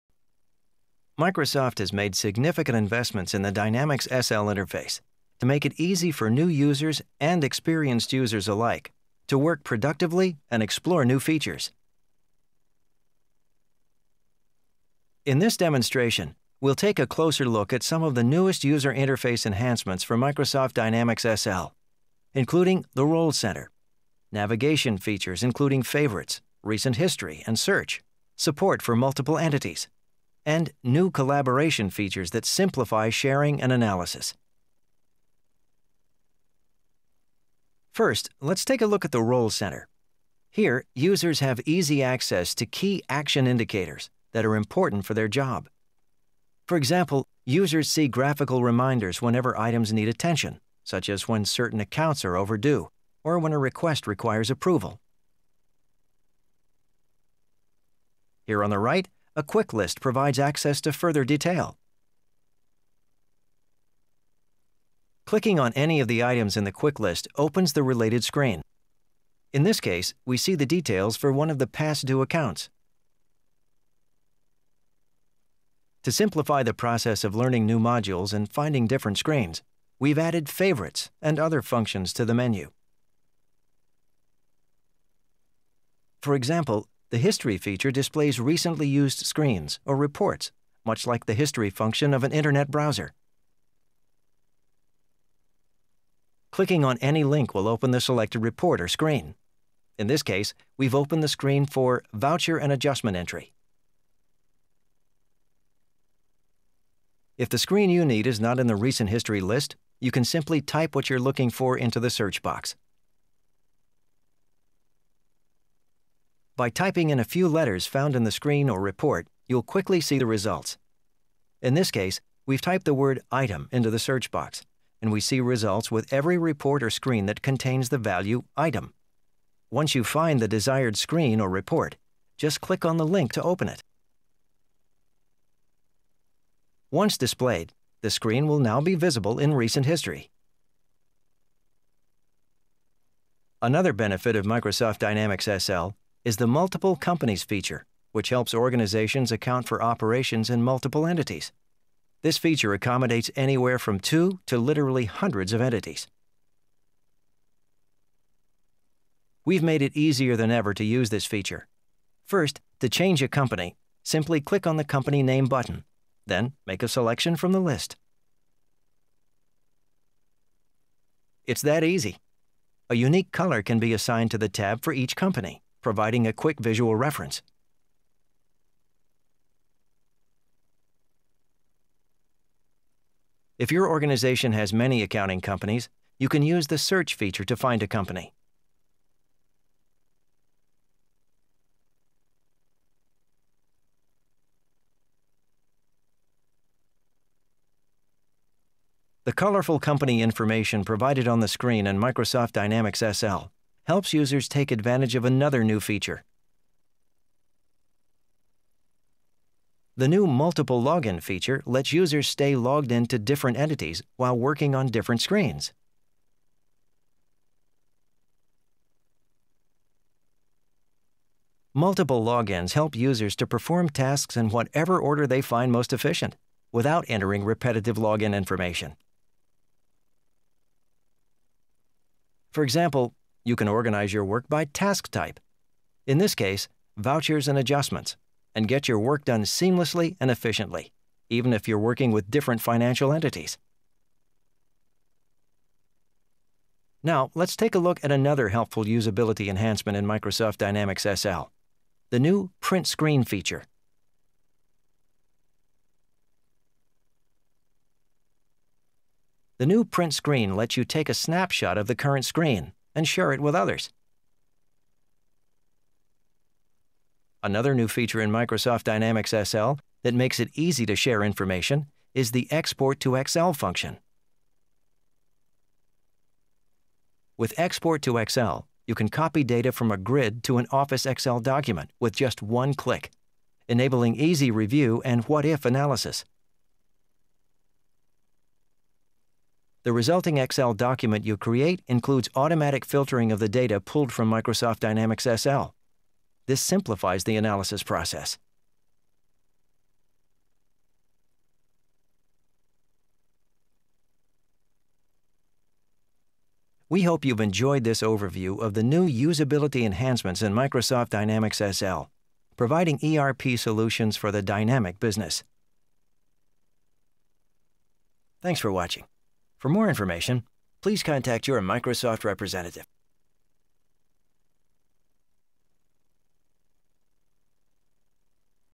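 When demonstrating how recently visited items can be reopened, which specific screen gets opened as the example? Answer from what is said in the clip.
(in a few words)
Voucher and Adjustment Entry.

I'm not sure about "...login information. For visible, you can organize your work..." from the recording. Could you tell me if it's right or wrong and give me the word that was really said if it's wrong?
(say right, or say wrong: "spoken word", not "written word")
wrong: "example", not "visible".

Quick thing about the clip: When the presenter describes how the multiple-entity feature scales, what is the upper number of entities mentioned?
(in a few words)
hundreds.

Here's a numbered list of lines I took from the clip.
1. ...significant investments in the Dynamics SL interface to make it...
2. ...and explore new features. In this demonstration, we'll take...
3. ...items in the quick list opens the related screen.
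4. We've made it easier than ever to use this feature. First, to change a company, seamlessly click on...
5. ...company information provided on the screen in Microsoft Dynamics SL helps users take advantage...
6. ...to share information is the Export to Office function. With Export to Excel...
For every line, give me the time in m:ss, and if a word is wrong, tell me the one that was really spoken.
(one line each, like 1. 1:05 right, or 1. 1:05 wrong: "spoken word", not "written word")
1. 0:02 right
2. 0:10 right
3. 1:06 right
4. 2:39 wrong: "simply", not "seamlessly"
5. 3:19 right
6. 4:30 wrong: "Excel", not "Office".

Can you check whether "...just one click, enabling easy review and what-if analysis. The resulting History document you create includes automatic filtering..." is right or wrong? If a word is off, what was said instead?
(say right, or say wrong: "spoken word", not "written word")
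wrong: "Excel", not "History".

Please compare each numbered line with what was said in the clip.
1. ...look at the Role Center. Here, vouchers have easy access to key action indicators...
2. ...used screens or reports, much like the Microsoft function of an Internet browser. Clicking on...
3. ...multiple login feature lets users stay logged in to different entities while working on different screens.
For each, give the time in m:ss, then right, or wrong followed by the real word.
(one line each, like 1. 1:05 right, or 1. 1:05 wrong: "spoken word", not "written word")
1. 0:38 wrong: "users", not "vouchers"
2. 1:28 wrong: "History", not "Microsoft"
3. 3:30 right.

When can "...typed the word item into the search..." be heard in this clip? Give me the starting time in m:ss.
2:02.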